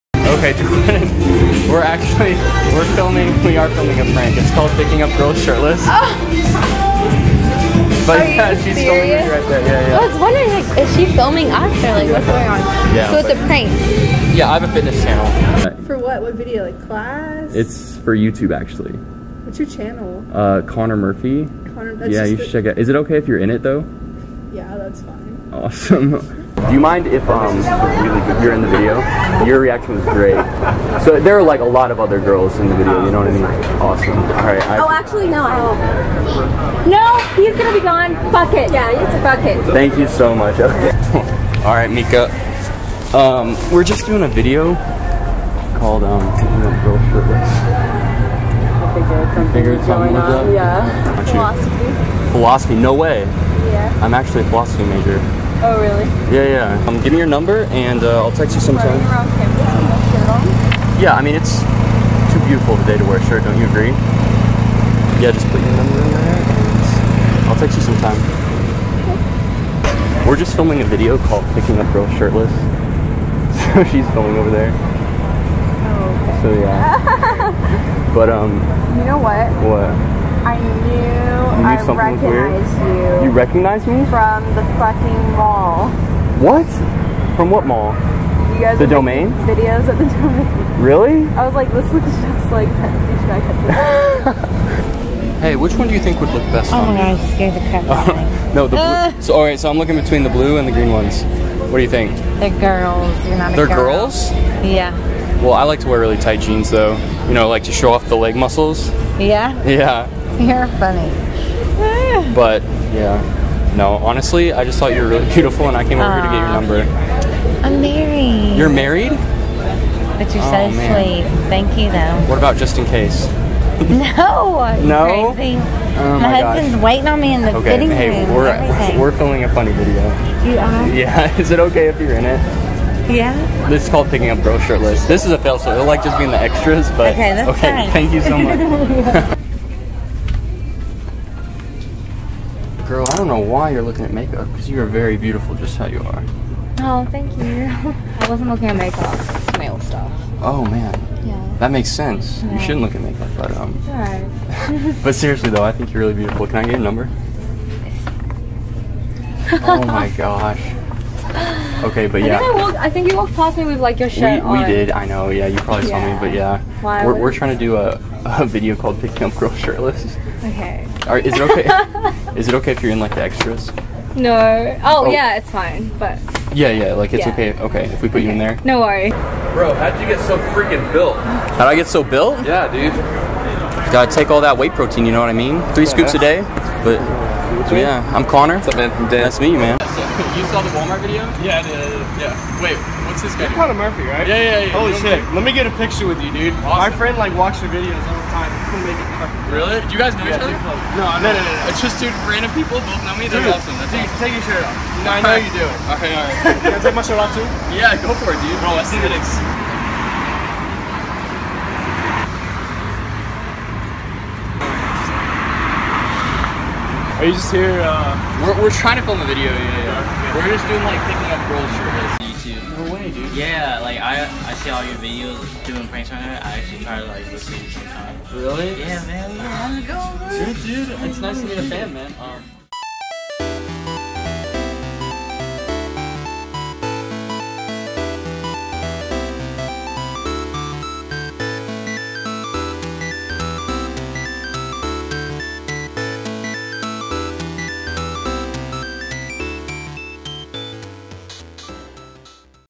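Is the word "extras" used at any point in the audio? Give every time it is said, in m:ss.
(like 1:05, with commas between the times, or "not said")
2:16, 2:53.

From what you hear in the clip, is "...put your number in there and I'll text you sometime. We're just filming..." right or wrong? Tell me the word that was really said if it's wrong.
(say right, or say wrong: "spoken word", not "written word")
right.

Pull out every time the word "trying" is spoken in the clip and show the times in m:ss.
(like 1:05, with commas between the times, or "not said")
2:47, 3:38.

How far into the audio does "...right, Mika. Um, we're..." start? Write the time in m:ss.
0:41.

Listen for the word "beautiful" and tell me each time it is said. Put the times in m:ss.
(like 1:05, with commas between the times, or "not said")
1:02, 1:55, 2:25, 2:36.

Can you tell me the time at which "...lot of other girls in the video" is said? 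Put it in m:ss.
0:31.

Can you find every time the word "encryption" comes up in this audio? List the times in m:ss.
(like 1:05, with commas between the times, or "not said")
not said.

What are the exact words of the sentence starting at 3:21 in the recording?
It's just dude, random people both know me.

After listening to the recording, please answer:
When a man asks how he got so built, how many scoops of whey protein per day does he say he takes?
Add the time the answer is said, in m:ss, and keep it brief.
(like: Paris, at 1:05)
3, at 3:05.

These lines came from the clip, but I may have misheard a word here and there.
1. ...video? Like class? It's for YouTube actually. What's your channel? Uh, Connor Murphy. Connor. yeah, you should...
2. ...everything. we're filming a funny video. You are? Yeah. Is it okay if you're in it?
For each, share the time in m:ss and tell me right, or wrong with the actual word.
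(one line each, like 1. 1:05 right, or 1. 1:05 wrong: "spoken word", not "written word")
1. 0:16 right
2. 2:08 right.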